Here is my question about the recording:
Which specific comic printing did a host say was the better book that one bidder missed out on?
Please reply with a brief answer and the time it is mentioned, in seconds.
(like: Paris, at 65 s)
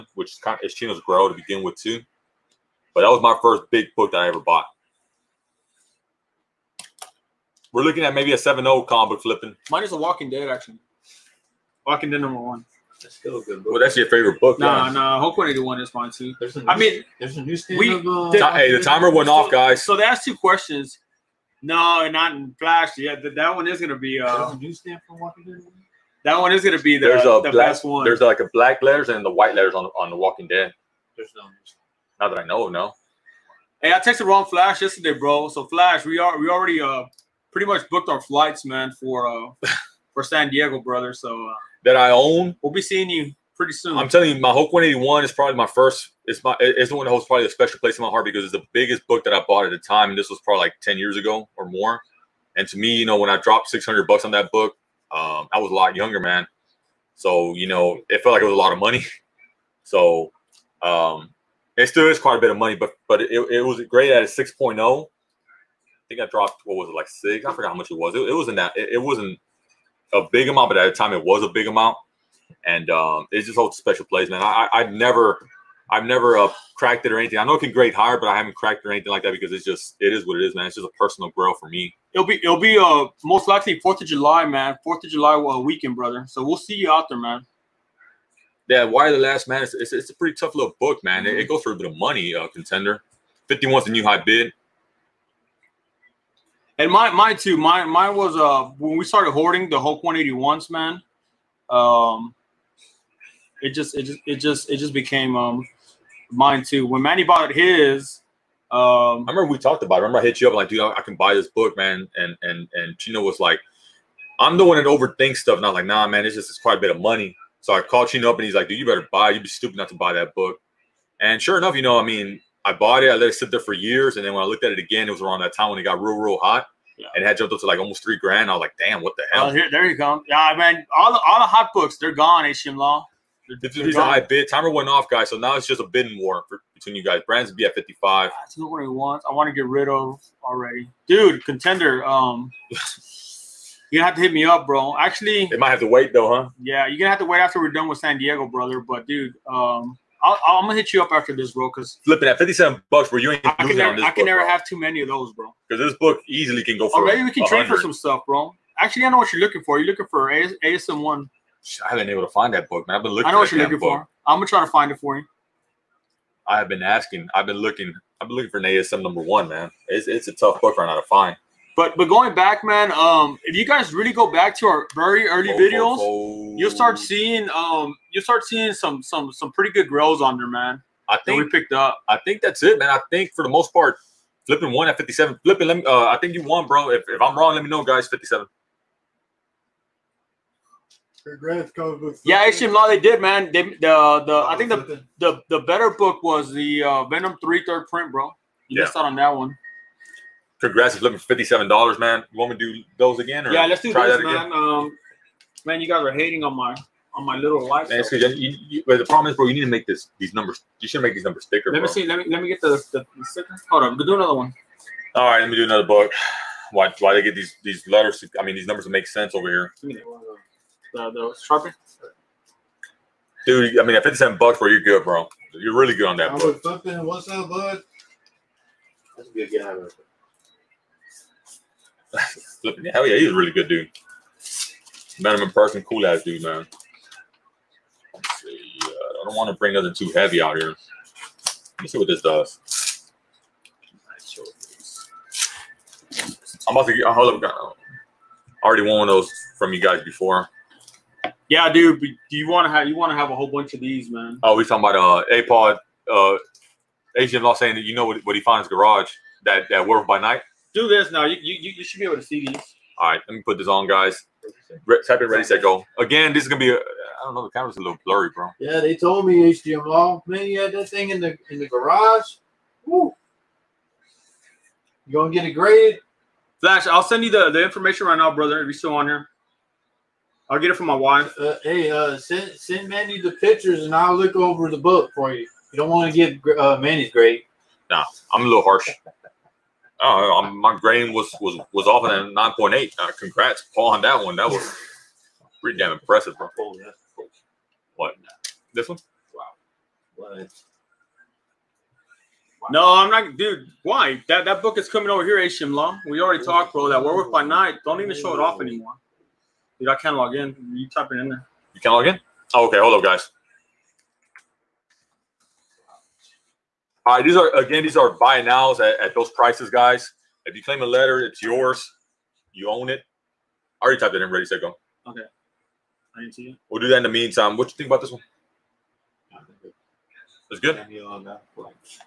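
Venom 3 third print, at 197 s.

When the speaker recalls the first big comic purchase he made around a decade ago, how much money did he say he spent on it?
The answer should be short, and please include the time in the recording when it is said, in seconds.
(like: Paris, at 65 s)
$600, at 53 s.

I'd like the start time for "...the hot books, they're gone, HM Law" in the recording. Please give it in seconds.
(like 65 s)
131 s.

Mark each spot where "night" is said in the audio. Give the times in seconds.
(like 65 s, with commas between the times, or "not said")
260 s, 307 s.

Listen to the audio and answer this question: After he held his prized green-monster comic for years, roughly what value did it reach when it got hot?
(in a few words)
3 grand.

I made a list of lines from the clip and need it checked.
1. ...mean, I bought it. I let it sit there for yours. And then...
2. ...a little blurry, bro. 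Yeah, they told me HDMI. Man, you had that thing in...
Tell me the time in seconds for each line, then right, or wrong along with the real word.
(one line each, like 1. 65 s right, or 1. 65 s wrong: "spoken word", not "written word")
1. 122 s wrong: "years", not "yours"
2. 267 s right.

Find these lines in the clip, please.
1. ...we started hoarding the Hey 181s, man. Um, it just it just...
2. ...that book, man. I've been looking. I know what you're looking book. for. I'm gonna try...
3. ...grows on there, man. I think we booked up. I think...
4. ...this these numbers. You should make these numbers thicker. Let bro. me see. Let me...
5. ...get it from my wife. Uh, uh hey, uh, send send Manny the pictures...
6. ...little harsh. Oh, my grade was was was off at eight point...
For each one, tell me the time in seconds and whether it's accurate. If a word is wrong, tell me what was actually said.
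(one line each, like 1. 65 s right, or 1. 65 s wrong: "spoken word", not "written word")
1. 98 s wrong: "Hulk", not "Hey"
2. 162 s right
3. 179 s wrong: "picked", not "booked"
4. 209 s right
5. 280 s right
6. 288 s wrong: "nine", not "eight".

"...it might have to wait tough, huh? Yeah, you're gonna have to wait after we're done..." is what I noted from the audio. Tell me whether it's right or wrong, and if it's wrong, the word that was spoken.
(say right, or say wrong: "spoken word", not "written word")
wrong: "though", not "tough".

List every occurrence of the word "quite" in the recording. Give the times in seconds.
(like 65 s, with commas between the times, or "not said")
62 s, 116 s.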